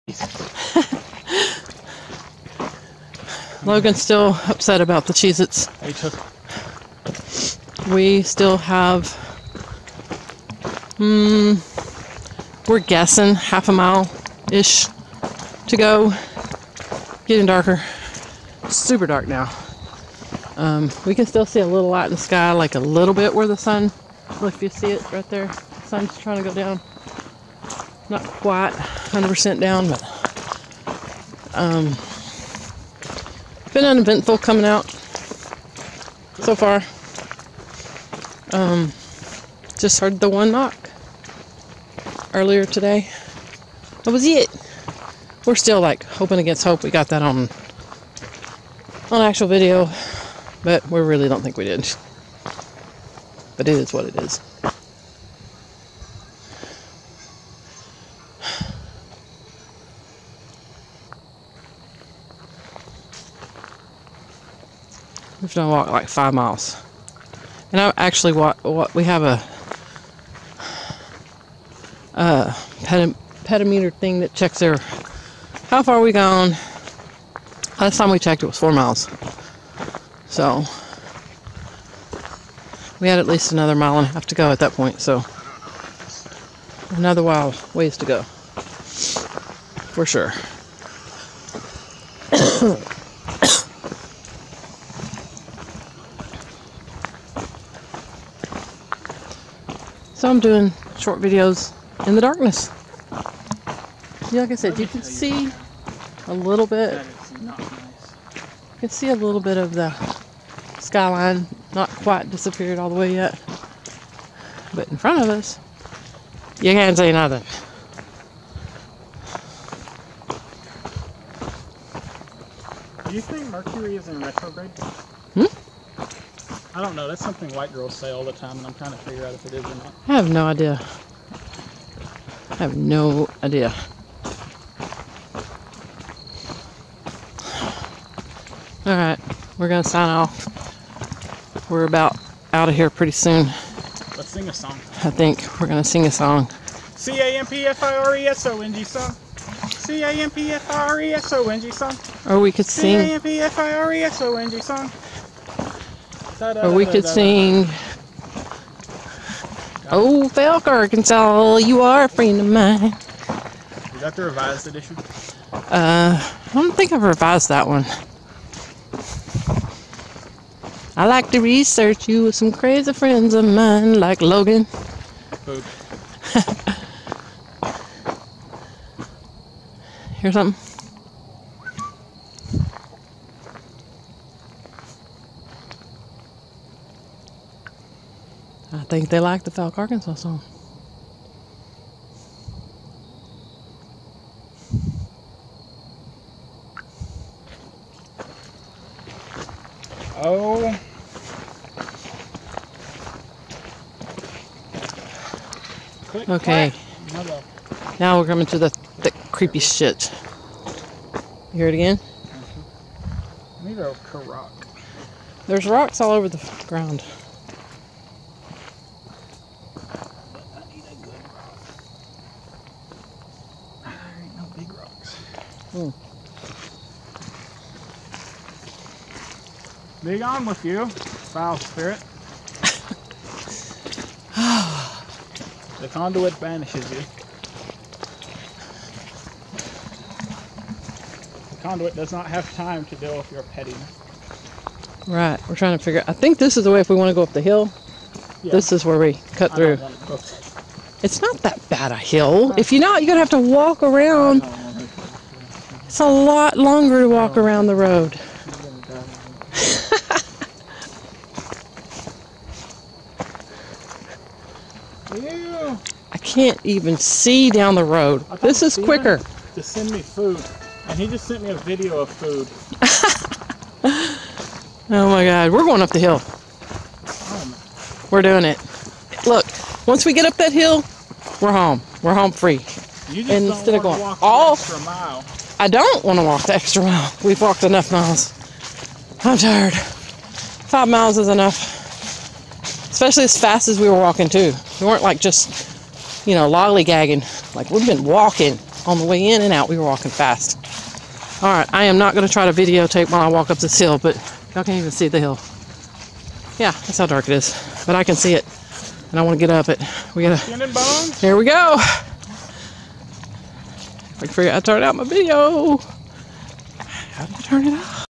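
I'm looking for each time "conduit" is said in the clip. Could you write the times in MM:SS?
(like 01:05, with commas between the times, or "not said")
03:55, 04:01.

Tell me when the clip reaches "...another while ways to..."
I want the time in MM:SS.
01:26.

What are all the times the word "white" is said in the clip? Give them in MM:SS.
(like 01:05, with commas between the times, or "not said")
02:07.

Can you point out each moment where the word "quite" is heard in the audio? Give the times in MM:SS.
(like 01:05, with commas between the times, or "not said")
00:28, 01:51.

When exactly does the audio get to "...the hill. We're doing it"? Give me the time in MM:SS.
04:35.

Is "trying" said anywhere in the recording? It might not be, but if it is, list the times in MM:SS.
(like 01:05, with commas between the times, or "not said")
00:26, 02:08, 04:05.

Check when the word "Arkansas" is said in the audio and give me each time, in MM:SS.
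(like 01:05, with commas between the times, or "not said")
02:40, 03:09.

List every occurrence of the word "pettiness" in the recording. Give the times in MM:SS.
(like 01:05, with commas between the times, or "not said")
04:03.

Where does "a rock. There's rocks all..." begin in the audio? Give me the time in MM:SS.
03:33.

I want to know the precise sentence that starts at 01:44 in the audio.
Yeah, like I said, you can see a little bit.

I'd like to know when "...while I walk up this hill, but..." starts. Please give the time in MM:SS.
05:03.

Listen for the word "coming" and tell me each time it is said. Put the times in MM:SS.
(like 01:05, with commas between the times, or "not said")
00:34, 03:28.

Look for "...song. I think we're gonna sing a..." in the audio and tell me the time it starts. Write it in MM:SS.
02:24.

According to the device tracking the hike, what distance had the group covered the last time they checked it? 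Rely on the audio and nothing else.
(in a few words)
4 miles.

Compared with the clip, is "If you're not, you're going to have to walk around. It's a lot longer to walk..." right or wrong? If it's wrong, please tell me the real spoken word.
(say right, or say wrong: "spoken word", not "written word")
right.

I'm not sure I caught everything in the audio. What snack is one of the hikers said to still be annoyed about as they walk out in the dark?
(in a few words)
Cheez Its.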